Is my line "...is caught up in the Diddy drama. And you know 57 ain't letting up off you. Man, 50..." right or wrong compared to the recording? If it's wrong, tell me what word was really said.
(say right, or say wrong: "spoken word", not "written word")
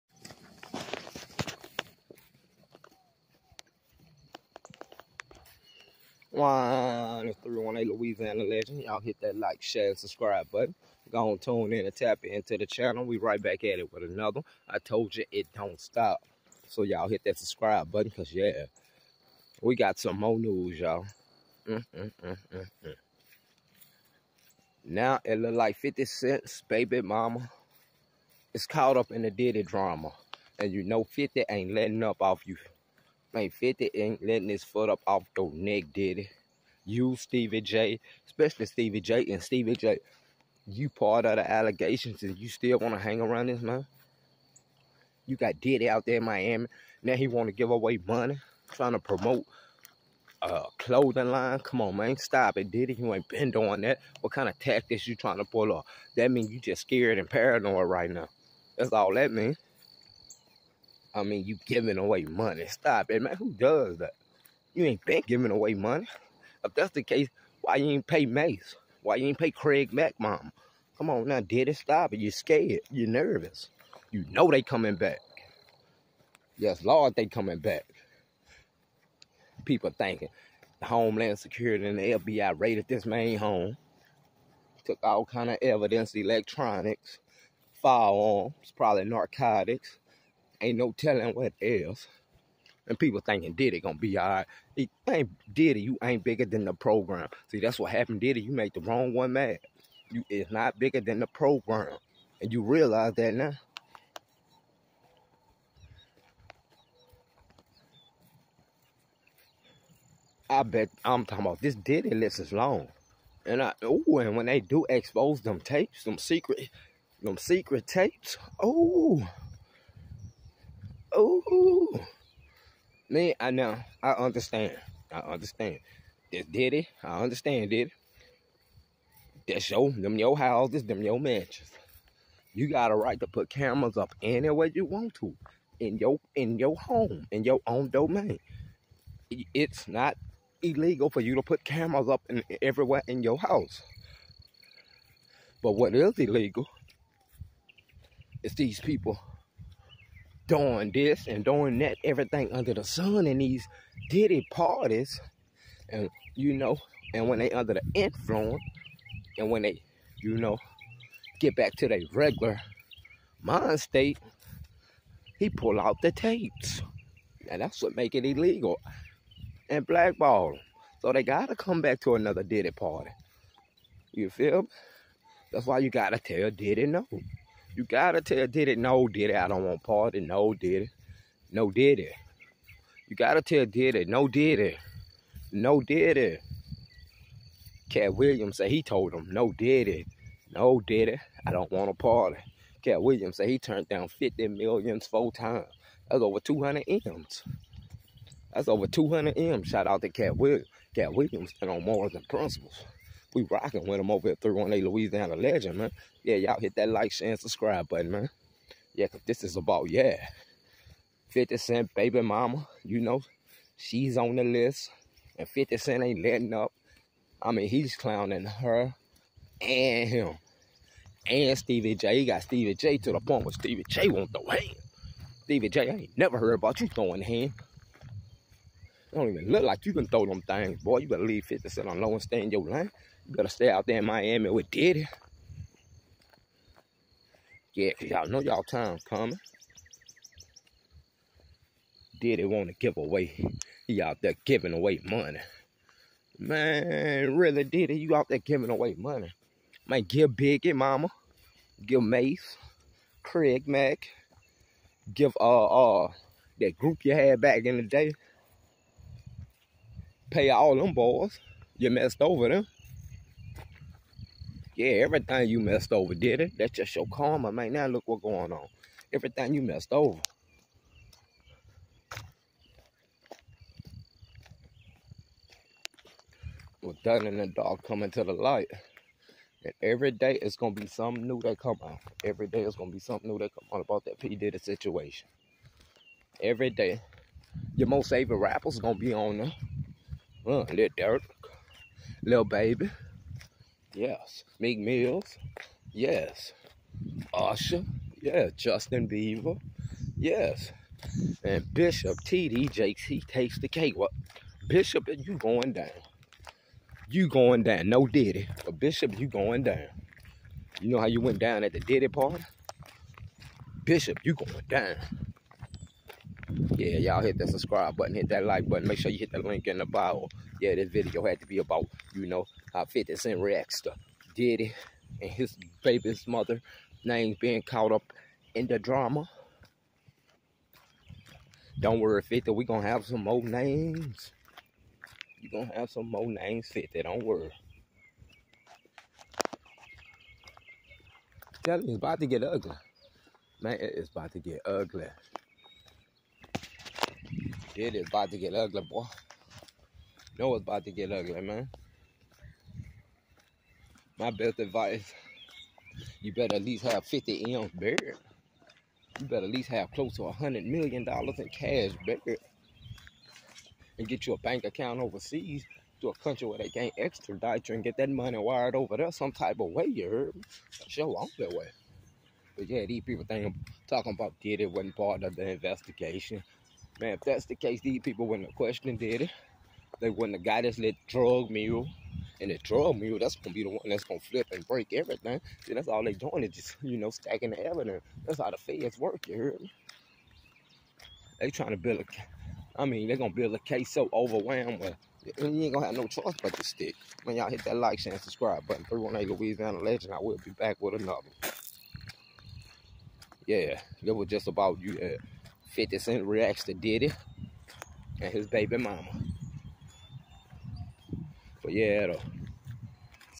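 wrong: "50", not "57".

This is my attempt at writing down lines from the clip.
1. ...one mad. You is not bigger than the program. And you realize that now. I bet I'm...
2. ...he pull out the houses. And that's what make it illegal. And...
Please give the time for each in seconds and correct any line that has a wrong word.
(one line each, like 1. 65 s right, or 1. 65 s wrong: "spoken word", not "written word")
1. 99 s right
2. 165 s wrong: "tapes", not "houses".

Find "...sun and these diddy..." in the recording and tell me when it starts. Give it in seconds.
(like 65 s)
152 s.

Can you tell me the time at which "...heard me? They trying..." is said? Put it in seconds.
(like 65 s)
389 s.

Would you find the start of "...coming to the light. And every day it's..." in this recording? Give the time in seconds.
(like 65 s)
277 s.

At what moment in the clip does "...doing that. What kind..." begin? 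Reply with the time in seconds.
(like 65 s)
53 s.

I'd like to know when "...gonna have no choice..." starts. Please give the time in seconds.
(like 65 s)
395 s.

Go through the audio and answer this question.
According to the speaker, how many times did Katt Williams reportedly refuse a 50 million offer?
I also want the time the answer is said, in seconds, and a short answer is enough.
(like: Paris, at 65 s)
4 times, at 195 s.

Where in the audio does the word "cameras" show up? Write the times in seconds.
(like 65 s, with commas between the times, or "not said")
133 s, 141 s.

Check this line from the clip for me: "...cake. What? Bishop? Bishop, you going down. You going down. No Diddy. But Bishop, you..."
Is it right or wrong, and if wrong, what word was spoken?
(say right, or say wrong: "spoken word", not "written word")
right.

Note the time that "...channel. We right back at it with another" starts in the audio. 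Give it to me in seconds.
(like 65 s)
12 s.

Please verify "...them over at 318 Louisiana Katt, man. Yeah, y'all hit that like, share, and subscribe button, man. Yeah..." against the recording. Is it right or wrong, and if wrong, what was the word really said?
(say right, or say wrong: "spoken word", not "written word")
wrong: "Legend", not "Katt".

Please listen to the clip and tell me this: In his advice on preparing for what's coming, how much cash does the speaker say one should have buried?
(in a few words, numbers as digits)
$100 million.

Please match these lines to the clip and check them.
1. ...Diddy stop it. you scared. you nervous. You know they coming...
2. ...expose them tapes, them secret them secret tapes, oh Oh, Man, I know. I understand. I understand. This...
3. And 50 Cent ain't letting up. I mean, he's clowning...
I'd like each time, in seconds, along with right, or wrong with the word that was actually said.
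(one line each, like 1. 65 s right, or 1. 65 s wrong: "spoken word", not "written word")
1. 71 s right
2. 114 s right
3. 215 s right.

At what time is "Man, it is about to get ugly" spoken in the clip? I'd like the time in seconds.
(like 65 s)
343 s.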